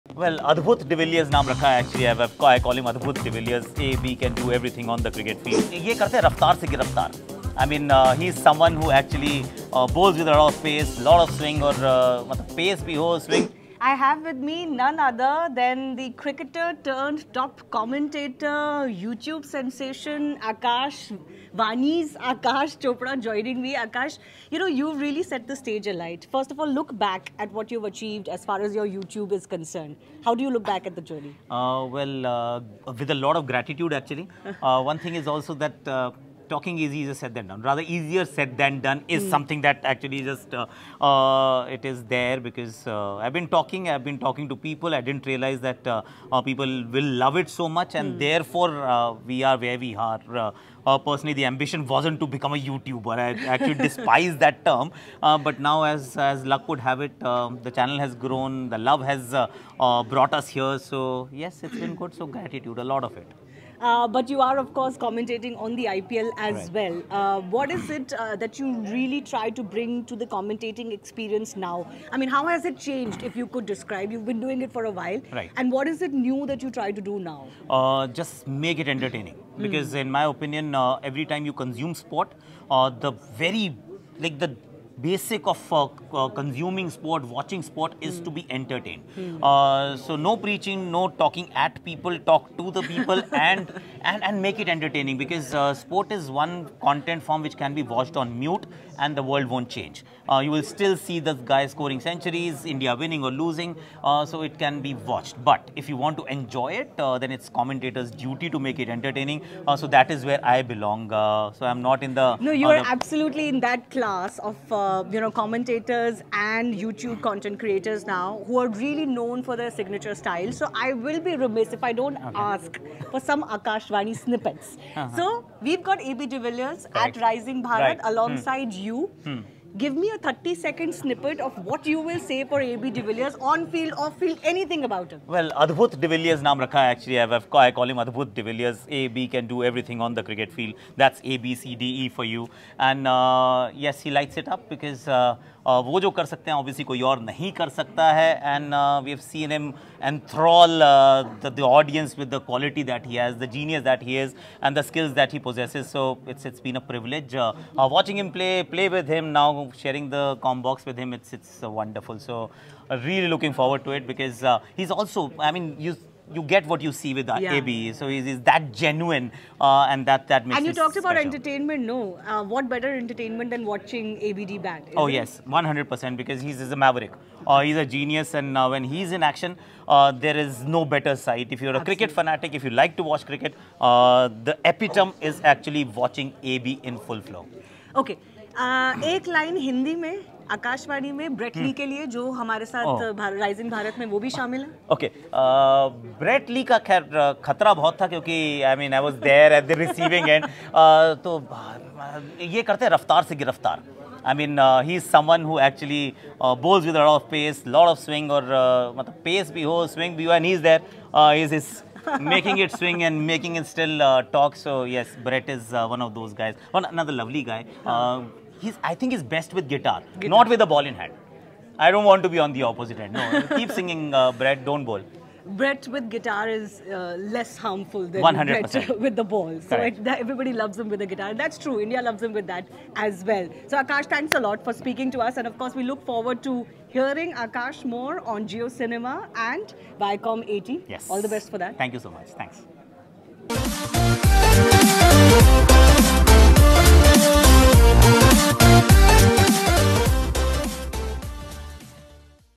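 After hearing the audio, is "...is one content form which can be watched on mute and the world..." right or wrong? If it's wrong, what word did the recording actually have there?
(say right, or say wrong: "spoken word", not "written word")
right.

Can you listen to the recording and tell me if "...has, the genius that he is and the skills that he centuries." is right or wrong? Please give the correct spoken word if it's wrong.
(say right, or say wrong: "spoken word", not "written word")
wrong: "possesses", not "centuries".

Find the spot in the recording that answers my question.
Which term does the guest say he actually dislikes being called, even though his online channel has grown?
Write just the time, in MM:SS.
00:52.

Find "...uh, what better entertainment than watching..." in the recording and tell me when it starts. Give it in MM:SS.
02:52.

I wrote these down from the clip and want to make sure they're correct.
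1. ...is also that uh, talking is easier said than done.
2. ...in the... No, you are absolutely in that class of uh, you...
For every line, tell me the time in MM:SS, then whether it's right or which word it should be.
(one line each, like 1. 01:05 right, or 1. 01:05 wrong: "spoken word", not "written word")
1. 00:35 right
2. 01:52 right.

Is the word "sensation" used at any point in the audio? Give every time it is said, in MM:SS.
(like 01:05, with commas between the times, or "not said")
00:19.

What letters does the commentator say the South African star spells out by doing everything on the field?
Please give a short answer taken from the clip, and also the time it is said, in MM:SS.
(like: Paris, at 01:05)
A, B, C, D, E, at 02:21.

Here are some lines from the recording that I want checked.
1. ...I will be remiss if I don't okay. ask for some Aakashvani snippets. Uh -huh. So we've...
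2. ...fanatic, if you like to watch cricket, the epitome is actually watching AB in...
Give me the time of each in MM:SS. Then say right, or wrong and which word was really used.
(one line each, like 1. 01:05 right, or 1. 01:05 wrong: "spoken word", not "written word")
1. 02:00 right
2. 03:02 right.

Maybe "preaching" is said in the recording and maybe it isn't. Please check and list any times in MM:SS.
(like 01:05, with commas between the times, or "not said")
01:30.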